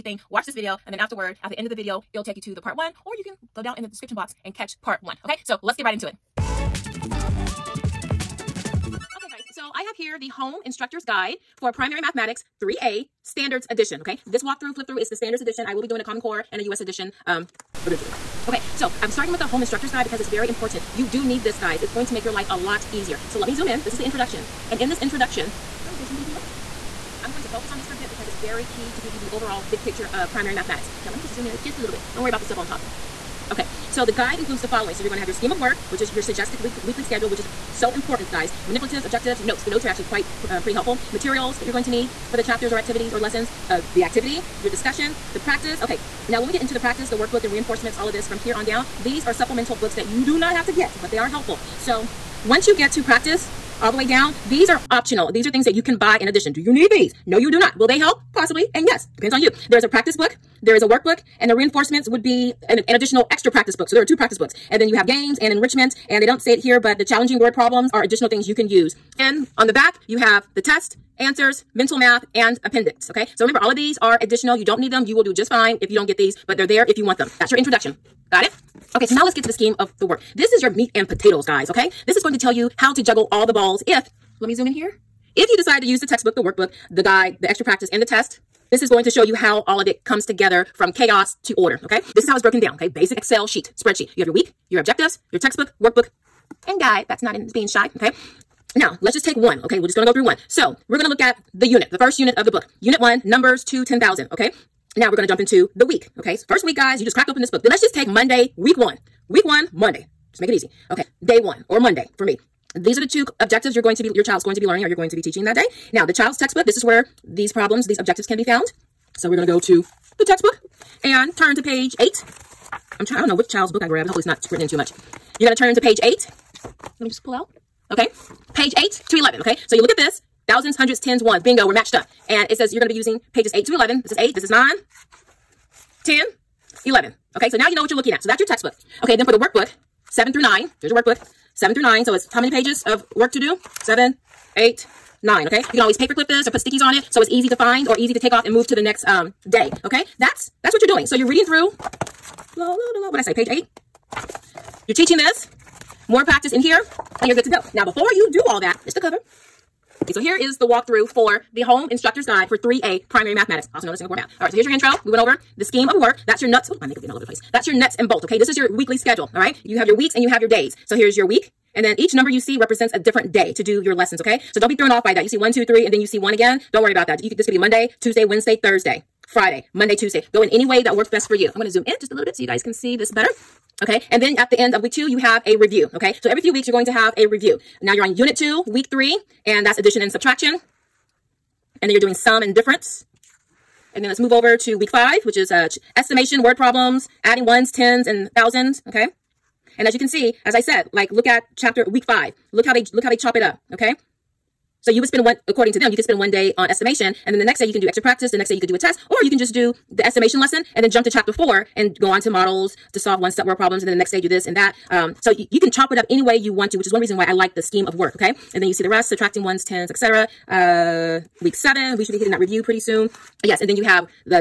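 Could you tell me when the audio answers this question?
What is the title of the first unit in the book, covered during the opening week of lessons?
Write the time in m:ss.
1:43.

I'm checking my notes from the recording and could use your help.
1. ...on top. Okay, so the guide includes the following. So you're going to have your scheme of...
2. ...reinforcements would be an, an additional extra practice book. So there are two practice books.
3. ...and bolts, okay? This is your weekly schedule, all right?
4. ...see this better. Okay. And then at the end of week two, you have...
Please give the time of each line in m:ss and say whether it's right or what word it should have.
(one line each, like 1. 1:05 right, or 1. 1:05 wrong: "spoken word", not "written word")
1. 0:32 right
2. 1:01 right
3. 2:47 right
4. 3:02 right.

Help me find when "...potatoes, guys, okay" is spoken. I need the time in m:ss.
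1:21.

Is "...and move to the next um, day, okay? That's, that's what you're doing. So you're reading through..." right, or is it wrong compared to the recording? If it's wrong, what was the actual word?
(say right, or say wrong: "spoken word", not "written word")
right.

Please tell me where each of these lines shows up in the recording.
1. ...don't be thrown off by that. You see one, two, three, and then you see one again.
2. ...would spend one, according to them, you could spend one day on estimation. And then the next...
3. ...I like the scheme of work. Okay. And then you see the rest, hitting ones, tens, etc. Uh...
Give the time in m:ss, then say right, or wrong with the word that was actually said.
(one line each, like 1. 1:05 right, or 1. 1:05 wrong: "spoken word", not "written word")
1. 2:54 right
2. 3:25 right
3. 3:37 wrong: "subtracting", not "hitting".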